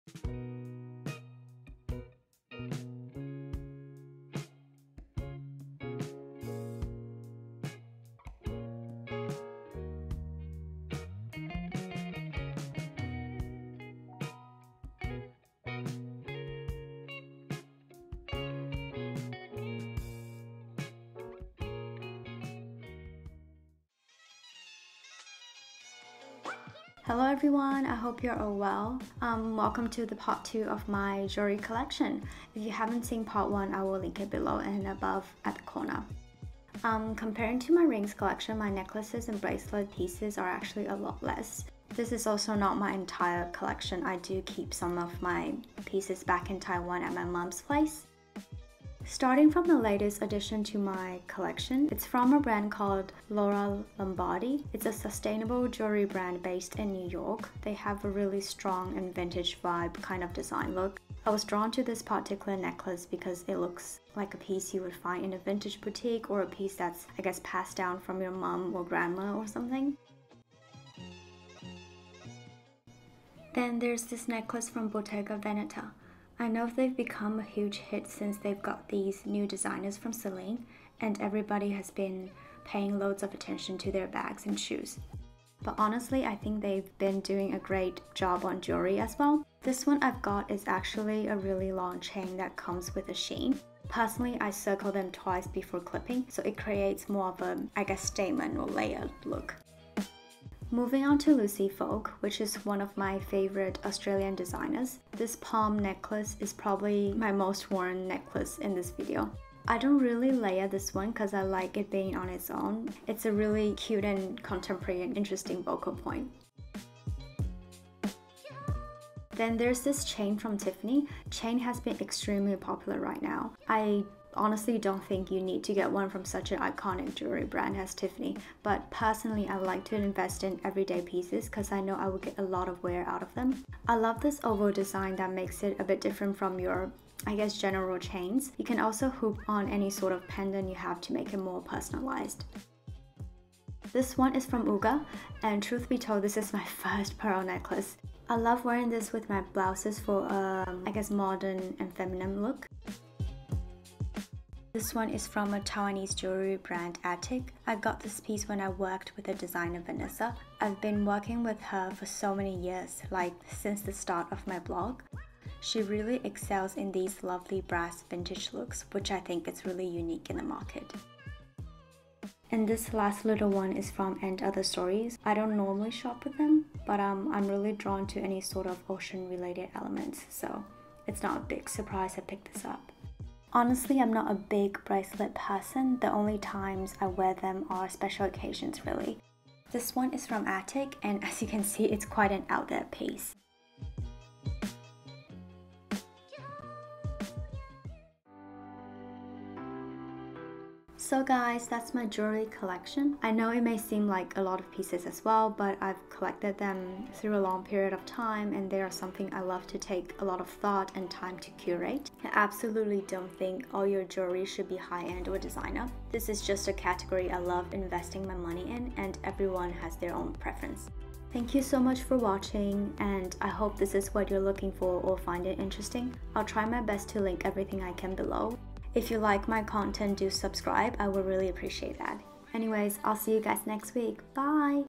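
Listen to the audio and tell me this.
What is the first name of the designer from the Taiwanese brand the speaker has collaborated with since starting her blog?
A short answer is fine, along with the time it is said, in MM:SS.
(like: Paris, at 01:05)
Vanessa, at 02:39.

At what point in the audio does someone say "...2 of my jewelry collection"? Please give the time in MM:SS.
00:30.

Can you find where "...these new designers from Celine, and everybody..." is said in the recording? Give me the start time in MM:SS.
01:18.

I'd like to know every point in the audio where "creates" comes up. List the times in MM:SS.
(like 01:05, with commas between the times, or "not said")
01:36.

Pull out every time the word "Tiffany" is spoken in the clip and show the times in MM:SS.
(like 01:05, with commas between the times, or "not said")
02:00, 02:07.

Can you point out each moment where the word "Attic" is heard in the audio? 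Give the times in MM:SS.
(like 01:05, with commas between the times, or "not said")
02:37, 03:10.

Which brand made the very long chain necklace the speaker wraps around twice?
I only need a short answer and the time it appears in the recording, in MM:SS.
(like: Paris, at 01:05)
Bottega Veneta, at 01:14.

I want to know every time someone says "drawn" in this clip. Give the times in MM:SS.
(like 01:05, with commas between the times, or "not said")
01:01, 02:57.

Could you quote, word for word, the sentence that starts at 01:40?
Moving on to Lucy Folk, which is one of my favorite Australian designers.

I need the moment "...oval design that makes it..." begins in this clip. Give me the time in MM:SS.
02:14.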